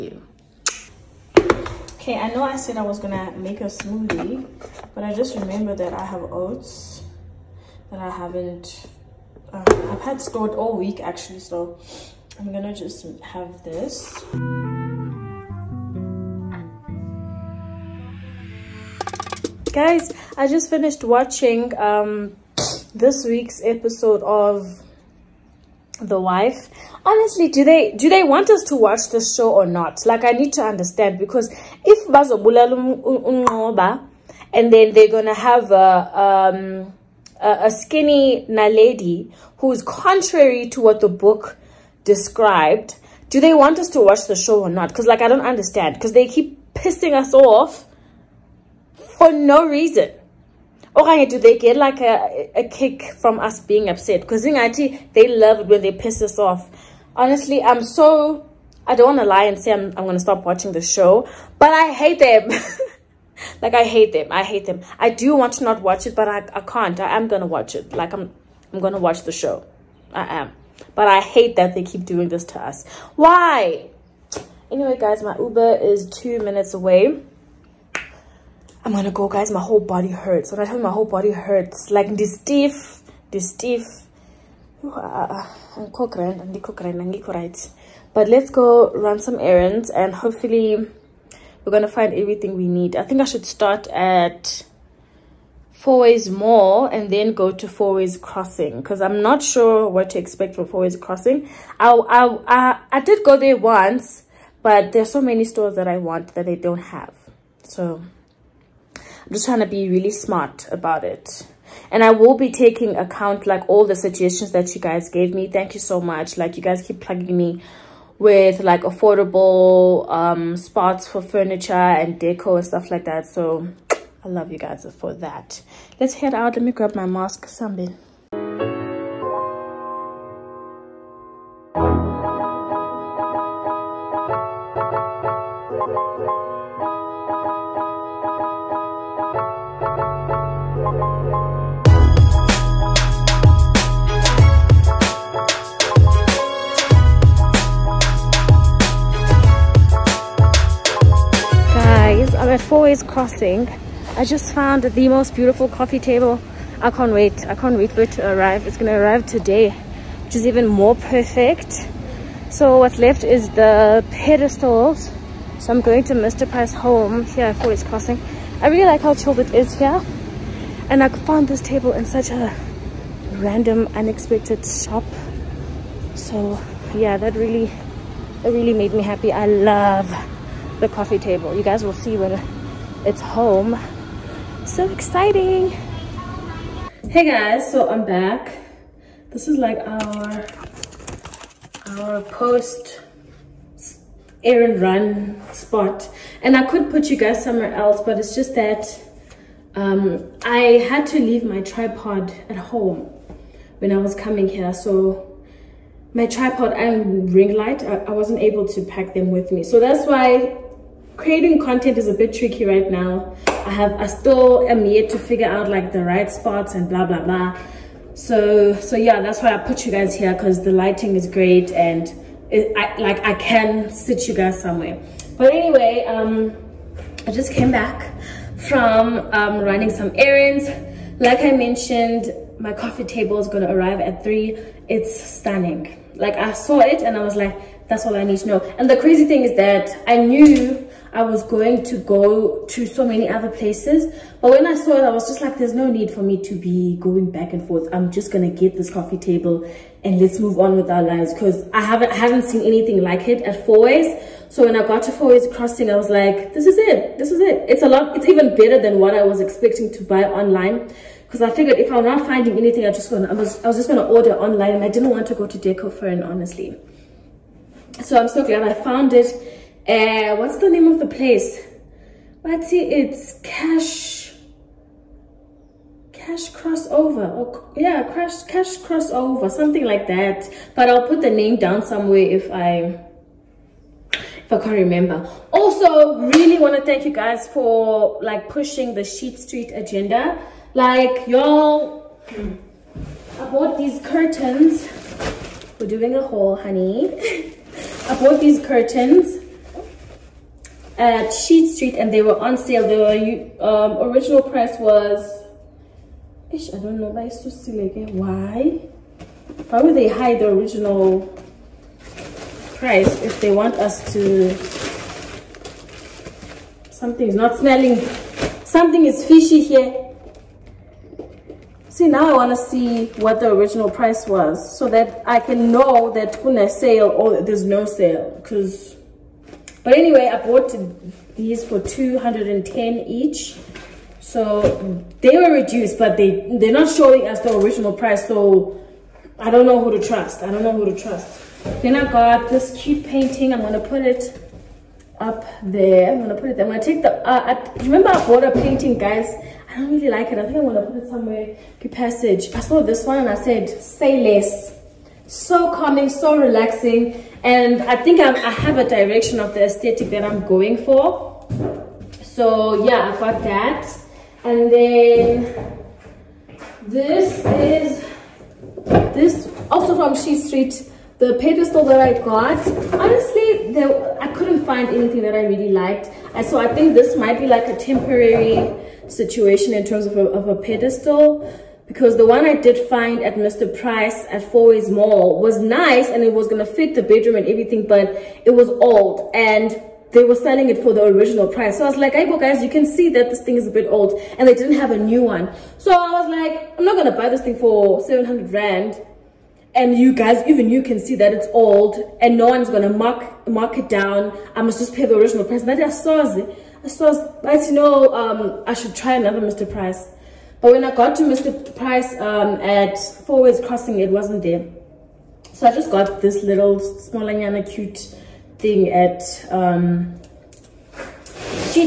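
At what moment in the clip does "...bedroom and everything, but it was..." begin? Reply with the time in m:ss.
6:27.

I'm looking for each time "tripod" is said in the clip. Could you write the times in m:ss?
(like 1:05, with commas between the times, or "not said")
3:21, 3:26.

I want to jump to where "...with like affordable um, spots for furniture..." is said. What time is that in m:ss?
1:58.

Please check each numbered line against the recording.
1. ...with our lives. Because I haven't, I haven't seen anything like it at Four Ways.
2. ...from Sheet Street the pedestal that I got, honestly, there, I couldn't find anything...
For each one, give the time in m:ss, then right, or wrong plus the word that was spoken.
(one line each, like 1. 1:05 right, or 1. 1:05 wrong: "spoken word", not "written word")
1. 4:10 right
2. 6:09 right.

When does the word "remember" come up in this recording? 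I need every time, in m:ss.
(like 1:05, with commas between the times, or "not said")
0:05, 4:44, 5:47.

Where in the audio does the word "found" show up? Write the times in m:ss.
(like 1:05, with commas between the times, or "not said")
2:34, 2:51, 4:28.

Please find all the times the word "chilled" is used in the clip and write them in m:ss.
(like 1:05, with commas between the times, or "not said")
2:49.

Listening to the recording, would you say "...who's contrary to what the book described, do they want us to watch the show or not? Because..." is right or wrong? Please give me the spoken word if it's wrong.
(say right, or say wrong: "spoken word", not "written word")
right.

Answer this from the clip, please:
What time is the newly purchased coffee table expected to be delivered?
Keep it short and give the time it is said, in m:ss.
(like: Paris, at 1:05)
3, at 3:54.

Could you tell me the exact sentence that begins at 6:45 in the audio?
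And I saw I saw But you know, um, I should try another Mr.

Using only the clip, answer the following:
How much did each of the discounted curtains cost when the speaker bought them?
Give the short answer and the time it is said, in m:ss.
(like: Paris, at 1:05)
210, at 5:31.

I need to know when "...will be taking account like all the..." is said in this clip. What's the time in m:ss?
1:52.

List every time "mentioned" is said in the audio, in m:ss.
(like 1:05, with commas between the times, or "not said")
3:51.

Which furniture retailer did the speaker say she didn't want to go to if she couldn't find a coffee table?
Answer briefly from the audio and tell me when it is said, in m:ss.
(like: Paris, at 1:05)
Decofurn, at 4:25.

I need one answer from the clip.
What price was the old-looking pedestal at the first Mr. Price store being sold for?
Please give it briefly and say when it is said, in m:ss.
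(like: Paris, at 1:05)
700 Rand, at 6:37.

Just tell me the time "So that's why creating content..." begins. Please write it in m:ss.
3:29.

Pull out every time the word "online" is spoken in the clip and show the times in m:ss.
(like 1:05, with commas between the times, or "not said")
4:20, 4:24.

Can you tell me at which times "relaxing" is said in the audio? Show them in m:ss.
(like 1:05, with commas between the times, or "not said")
5:56.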